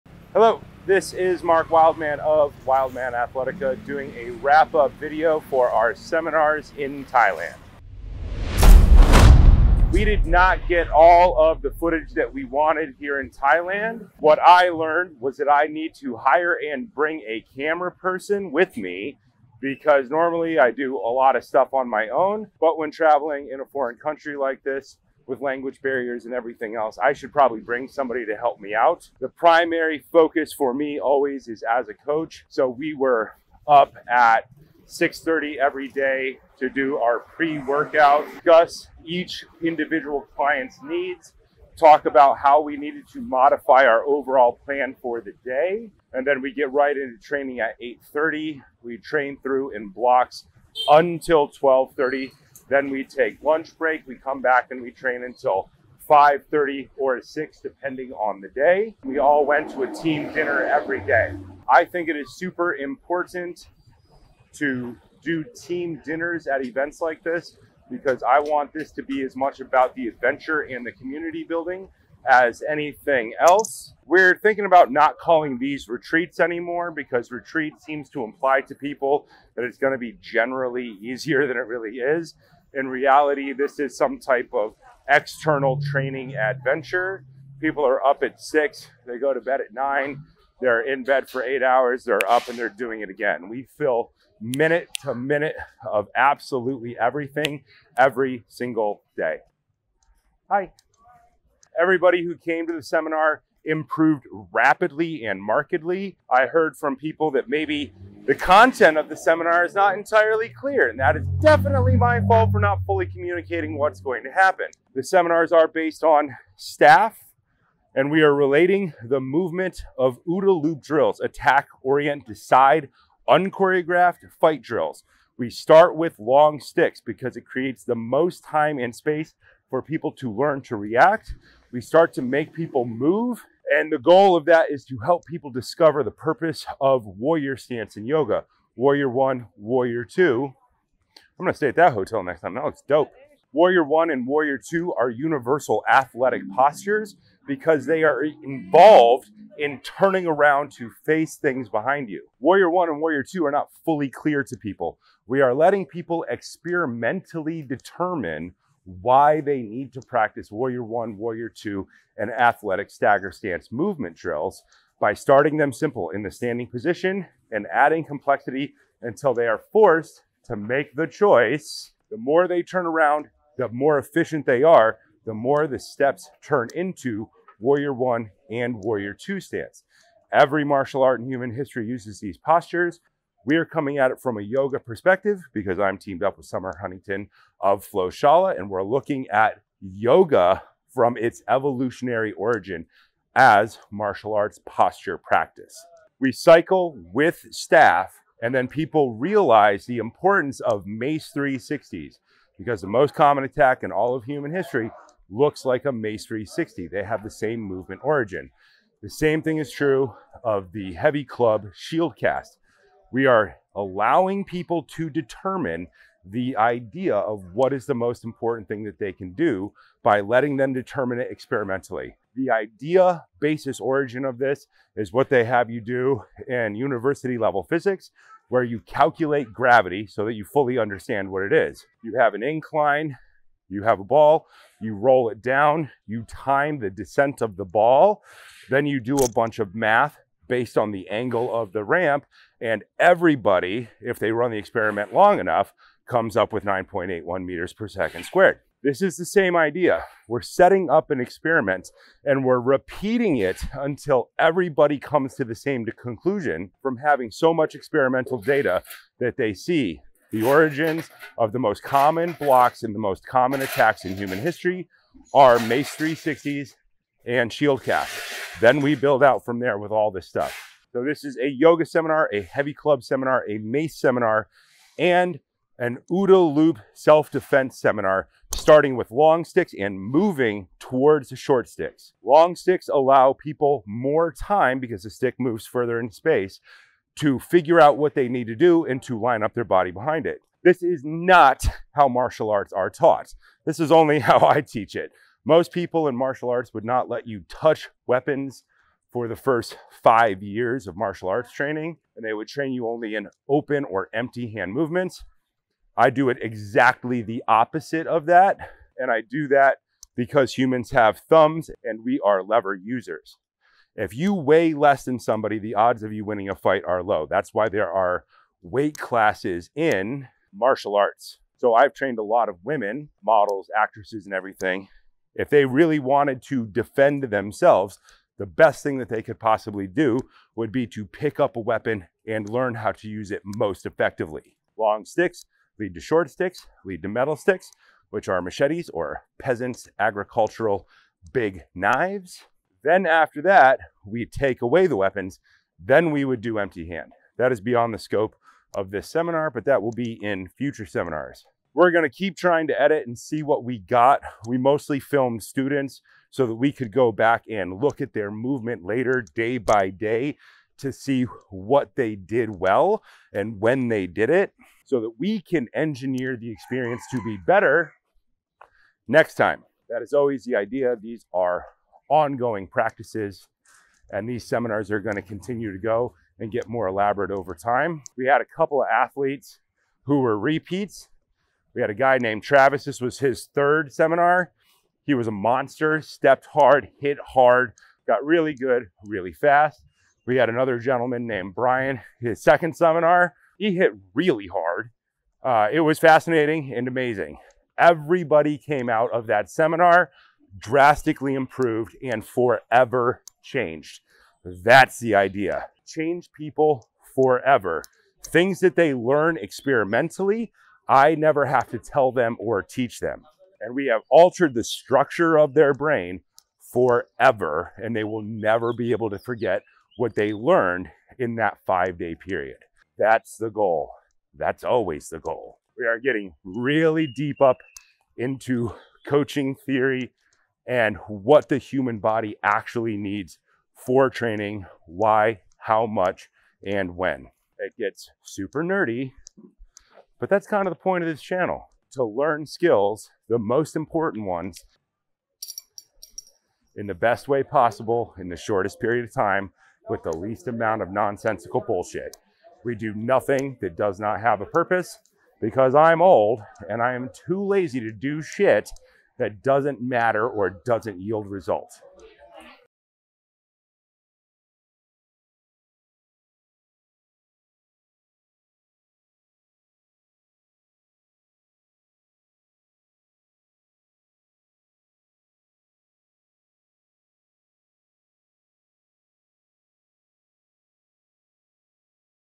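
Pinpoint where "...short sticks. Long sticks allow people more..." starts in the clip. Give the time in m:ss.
4:41.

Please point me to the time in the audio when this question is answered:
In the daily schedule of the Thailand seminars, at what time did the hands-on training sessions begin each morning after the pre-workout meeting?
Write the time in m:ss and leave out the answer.
0:47.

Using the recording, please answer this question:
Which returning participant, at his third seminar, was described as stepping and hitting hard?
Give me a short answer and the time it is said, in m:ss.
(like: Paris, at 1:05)
Travis, at 6:22.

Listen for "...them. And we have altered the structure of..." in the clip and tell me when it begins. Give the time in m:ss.
6:52.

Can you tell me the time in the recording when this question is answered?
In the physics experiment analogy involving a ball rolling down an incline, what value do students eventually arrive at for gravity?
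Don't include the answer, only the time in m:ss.
4:06.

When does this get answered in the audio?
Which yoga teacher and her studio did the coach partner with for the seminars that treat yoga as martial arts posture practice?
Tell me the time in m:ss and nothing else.
3:06.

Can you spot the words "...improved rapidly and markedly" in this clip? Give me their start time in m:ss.
1:43.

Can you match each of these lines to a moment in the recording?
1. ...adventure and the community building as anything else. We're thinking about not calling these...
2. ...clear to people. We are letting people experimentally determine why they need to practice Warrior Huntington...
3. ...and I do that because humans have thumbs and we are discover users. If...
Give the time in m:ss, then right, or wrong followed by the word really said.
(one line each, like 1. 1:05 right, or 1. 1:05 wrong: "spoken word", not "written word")
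1. 1:10 right
2. 2:34 wrong: "One", not "Huntington"
3. 5:08 wrong: "lever", not "discover".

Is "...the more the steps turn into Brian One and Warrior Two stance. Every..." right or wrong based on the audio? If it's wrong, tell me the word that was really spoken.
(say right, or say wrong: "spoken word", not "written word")
wrong: "Warrior", not "Brian".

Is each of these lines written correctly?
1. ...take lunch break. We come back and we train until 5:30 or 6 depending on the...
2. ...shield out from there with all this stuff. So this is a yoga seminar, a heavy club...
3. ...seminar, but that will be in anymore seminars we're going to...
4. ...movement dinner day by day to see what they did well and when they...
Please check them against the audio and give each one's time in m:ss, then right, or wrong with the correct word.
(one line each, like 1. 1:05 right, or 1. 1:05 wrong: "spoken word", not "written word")
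1. 0:53 right
2. 4:28 wrong: "build", not "shield"
3. 5:49 wrong: "future", not "anymore"
4. 5:58 wrong: "later", not "dinner".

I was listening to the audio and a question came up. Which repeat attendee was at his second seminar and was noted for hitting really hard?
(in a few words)
Brian.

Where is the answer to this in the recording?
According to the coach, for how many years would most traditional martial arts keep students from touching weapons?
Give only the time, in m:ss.
5:00.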